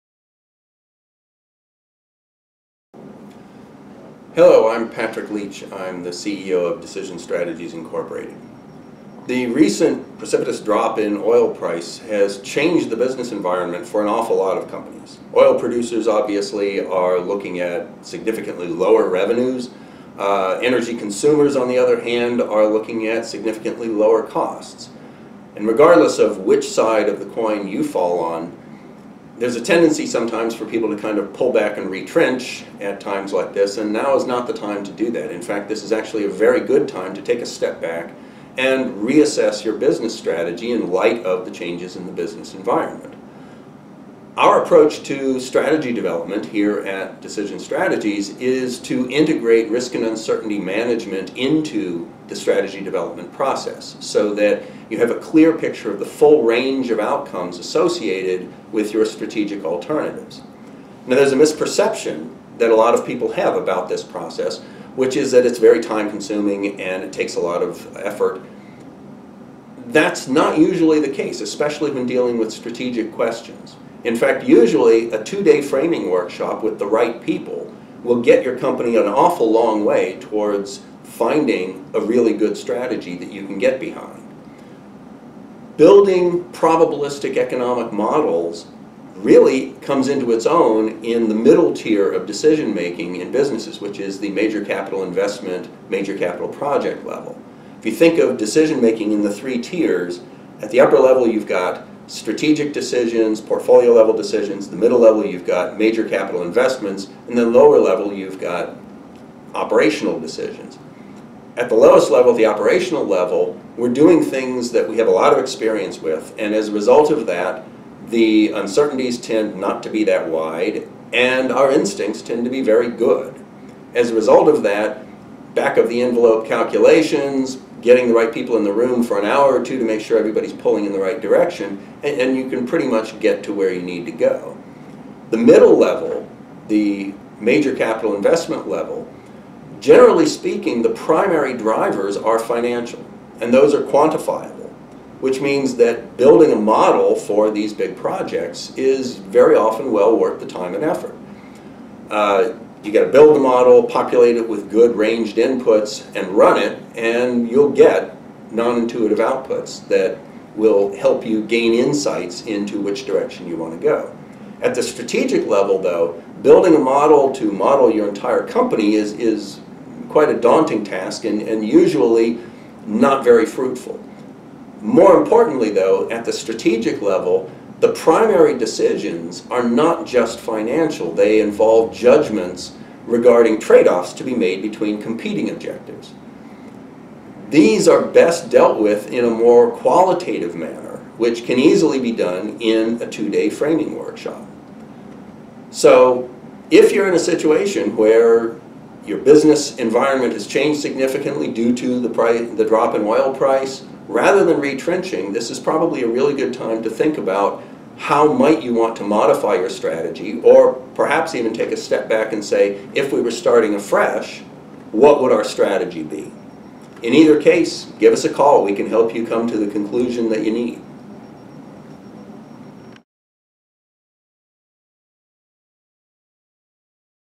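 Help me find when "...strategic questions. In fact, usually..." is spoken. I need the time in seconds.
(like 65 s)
72 s.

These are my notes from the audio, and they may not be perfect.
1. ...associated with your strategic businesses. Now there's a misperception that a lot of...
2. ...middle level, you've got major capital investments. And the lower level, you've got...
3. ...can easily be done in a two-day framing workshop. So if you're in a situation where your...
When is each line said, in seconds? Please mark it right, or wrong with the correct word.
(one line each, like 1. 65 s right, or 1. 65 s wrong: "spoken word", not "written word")
1. 57 s wrong: "alternatives", not "businesses"
2. 104 s right
3. 191 s right.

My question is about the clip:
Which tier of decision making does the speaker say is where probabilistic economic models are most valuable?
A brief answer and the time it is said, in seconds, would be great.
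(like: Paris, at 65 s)
middle tier, at 91 s.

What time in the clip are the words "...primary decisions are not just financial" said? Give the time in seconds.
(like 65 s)
177 s.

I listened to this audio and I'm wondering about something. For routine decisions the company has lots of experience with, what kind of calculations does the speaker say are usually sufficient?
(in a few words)
back of the envelope.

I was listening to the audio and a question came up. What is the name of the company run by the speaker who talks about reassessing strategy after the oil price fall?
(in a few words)
Decision Strategies Incorporated.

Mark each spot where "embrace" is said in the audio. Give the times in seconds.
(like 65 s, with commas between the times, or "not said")
not said.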